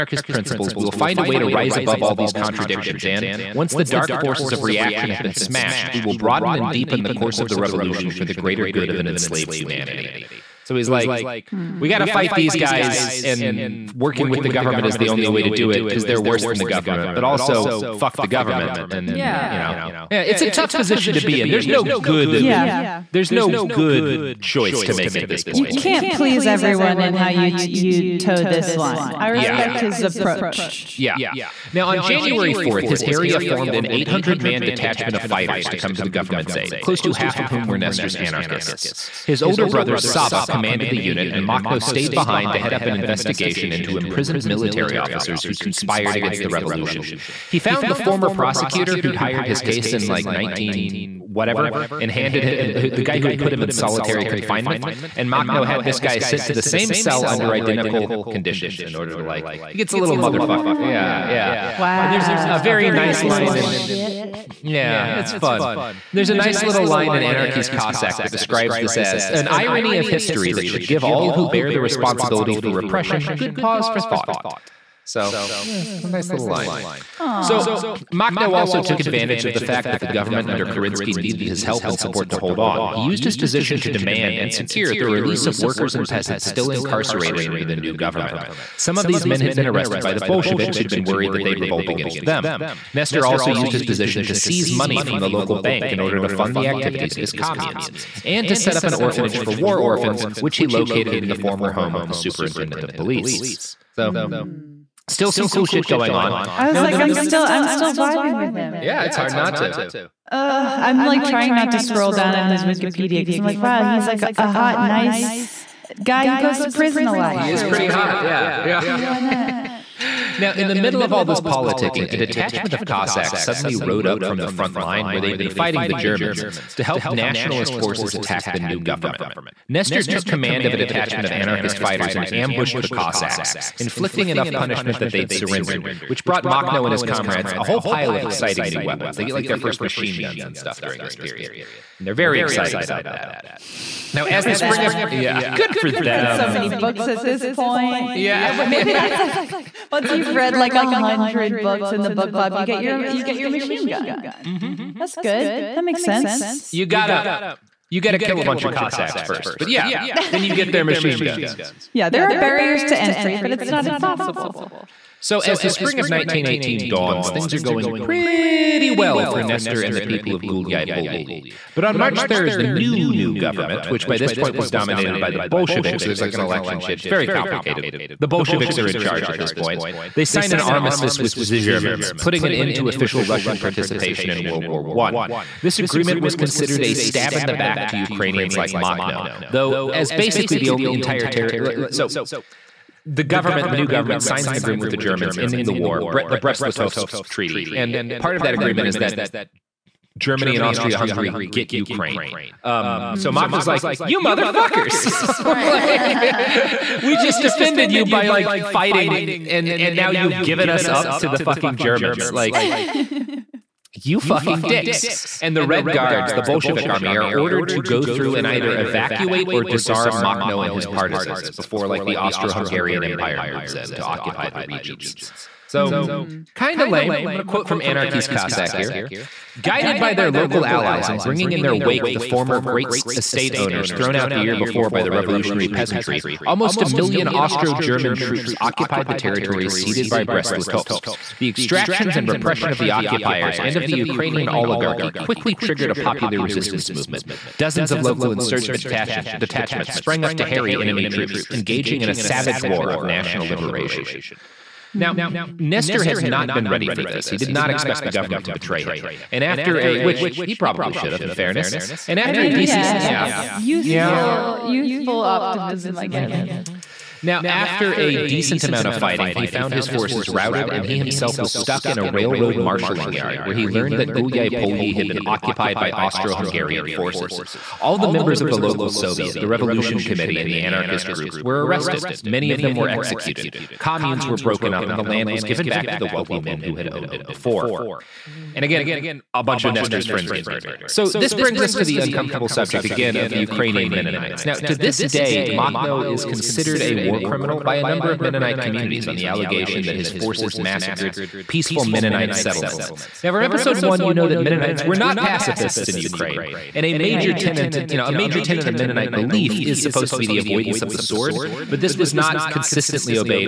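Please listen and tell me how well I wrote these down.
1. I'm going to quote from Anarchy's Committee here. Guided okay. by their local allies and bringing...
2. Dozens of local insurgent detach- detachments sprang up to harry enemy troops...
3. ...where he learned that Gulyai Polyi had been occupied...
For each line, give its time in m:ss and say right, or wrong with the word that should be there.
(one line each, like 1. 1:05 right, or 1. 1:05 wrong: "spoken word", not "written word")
1. 3:47 wrong: "Cossack", not "Committee"
2. 4:07 right
3. 4:33 right.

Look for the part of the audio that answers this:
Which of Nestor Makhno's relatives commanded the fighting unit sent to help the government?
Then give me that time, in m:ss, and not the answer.
0:39.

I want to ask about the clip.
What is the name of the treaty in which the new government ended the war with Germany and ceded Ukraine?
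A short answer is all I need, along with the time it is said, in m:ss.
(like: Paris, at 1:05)
Brest-Litovsk Treaty, at 3:16.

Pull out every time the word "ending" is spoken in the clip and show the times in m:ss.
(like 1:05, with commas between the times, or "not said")
3:15.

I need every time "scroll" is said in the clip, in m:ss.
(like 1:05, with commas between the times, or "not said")
1:51.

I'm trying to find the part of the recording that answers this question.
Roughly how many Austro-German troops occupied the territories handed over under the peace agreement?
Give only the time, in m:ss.
3:56.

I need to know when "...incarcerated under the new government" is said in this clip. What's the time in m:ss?
1:26.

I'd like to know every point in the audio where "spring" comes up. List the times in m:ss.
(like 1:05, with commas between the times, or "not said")
2:24, 2:45.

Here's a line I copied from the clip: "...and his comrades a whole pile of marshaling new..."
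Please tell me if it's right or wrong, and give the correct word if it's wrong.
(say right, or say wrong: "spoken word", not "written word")
wrong: "exciting", not "marshaling".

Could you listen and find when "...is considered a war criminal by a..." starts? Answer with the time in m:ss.
4:56.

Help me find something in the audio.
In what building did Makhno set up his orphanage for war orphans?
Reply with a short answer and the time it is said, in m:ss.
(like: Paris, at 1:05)
Former home of the superintendent of police, at 1:42.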